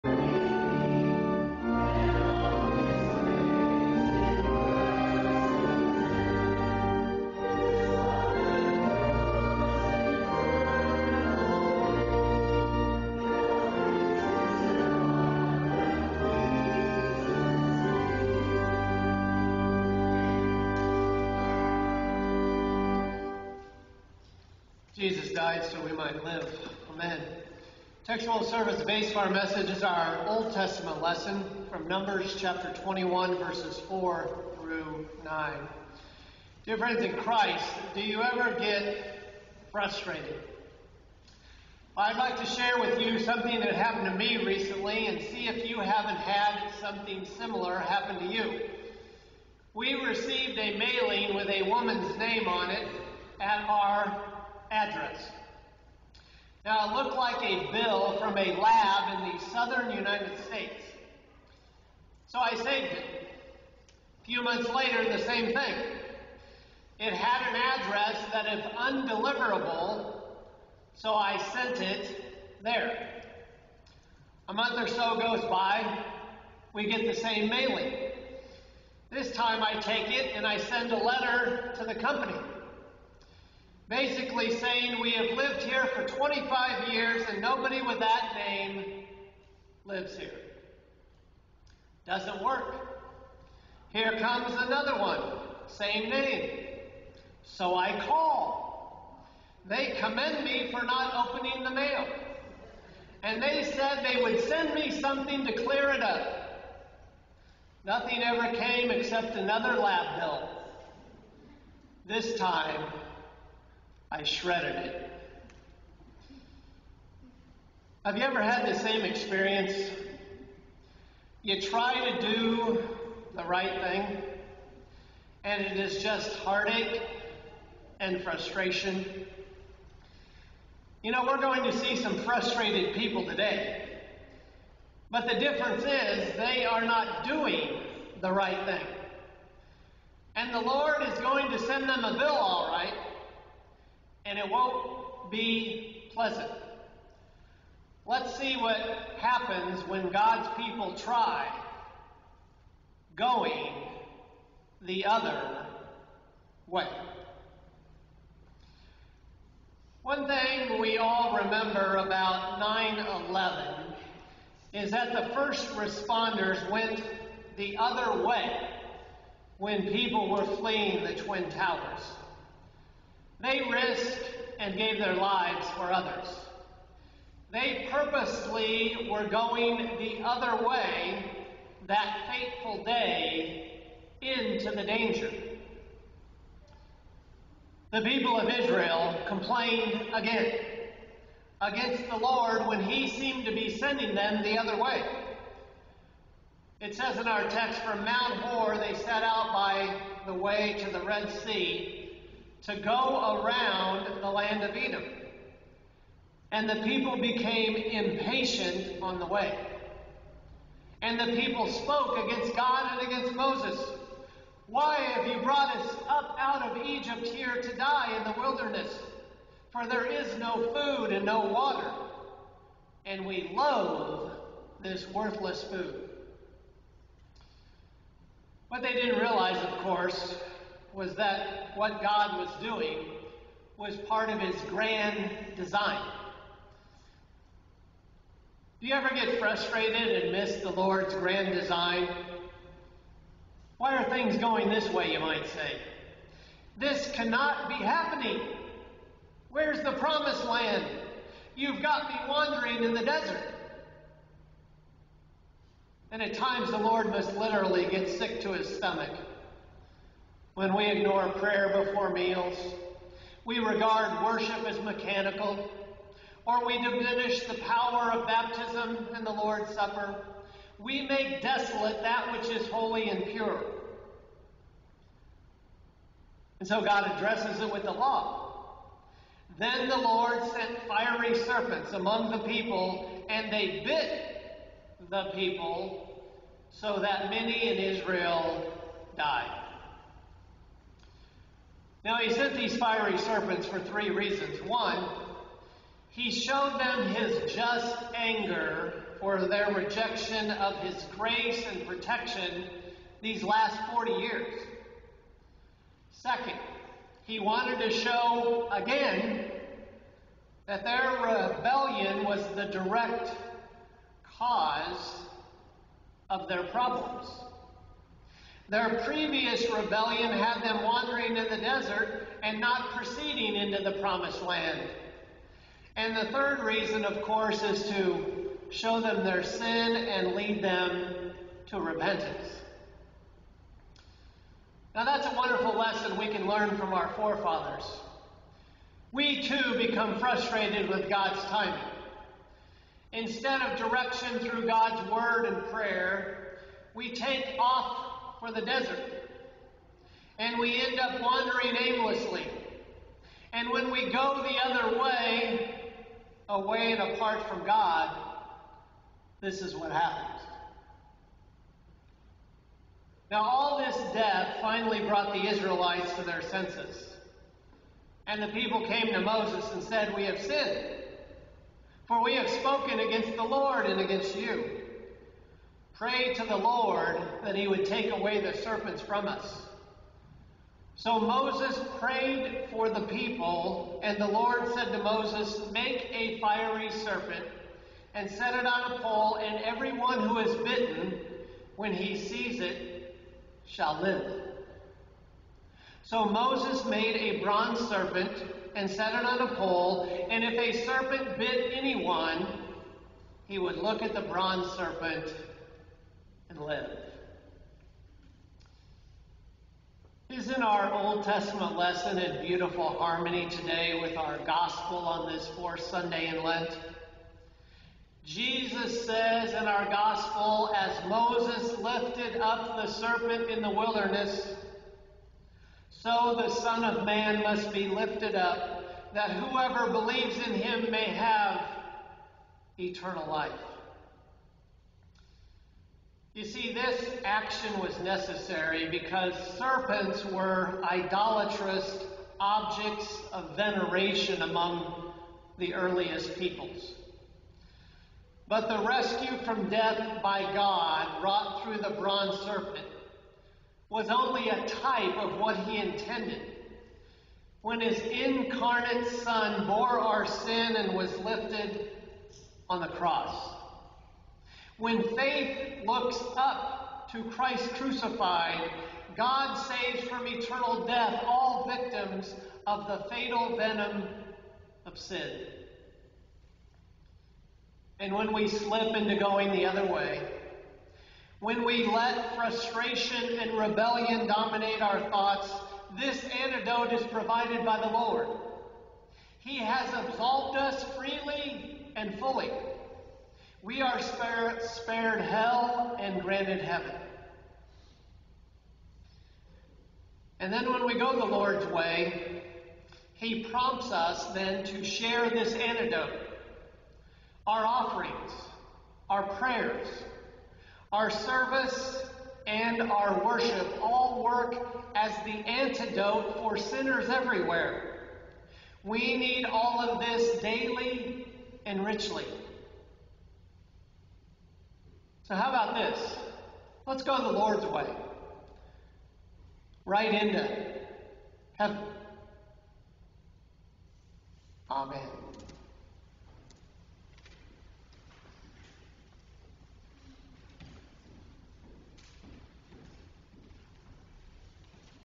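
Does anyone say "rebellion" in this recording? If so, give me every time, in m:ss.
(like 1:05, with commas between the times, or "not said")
5:11, 5:19, 8:03.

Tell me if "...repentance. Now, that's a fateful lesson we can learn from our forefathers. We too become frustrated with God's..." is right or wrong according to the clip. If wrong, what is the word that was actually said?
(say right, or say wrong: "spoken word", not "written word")
wrong: "wonderful", not "fateful".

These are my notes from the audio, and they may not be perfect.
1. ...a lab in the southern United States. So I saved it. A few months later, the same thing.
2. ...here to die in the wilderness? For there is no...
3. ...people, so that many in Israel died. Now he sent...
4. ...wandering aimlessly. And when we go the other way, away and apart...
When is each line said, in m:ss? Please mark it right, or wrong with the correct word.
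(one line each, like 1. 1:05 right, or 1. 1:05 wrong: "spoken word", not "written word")
1. 0:58 right
2. 3:37 right
3. 4:45 right
4. 5:51 right.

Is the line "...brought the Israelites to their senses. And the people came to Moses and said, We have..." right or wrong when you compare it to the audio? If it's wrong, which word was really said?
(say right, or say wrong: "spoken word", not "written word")
right.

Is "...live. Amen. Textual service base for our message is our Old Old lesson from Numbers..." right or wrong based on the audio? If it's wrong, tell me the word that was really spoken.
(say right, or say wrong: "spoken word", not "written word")
wrong: "Testament", not "Old".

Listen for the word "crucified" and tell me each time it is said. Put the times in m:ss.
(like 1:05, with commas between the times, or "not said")
7:47.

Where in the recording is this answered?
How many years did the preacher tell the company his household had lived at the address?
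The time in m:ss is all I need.
1:26.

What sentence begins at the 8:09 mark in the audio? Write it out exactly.
He has absolved us freely and fully.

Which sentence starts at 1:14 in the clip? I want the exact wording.
A month or so goes by, we get the same mailing.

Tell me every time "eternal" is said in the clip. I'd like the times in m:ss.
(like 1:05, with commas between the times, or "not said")
7:12, 7:50.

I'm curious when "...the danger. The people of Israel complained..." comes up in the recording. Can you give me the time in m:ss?
3:04.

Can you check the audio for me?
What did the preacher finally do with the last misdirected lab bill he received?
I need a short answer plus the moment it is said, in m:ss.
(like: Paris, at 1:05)
Shredded it, at 1:54.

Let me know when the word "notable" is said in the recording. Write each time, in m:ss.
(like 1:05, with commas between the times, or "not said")
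not said.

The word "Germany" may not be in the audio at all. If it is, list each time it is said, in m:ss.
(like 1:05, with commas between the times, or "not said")
not said.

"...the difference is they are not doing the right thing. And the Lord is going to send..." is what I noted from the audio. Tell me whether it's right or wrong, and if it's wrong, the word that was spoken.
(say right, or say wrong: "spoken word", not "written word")
right.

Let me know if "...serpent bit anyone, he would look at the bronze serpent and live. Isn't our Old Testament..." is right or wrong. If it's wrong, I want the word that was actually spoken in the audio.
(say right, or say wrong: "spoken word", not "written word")
right.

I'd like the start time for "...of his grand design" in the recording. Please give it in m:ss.
3:54.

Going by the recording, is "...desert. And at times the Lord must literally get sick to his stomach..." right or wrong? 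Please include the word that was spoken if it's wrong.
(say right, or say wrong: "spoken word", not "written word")
right.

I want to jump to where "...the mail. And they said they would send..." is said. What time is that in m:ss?
1:41.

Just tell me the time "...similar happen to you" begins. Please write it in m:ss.
0:47.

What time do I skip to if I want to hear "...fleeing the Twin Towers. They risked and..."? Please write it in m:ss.
2:50.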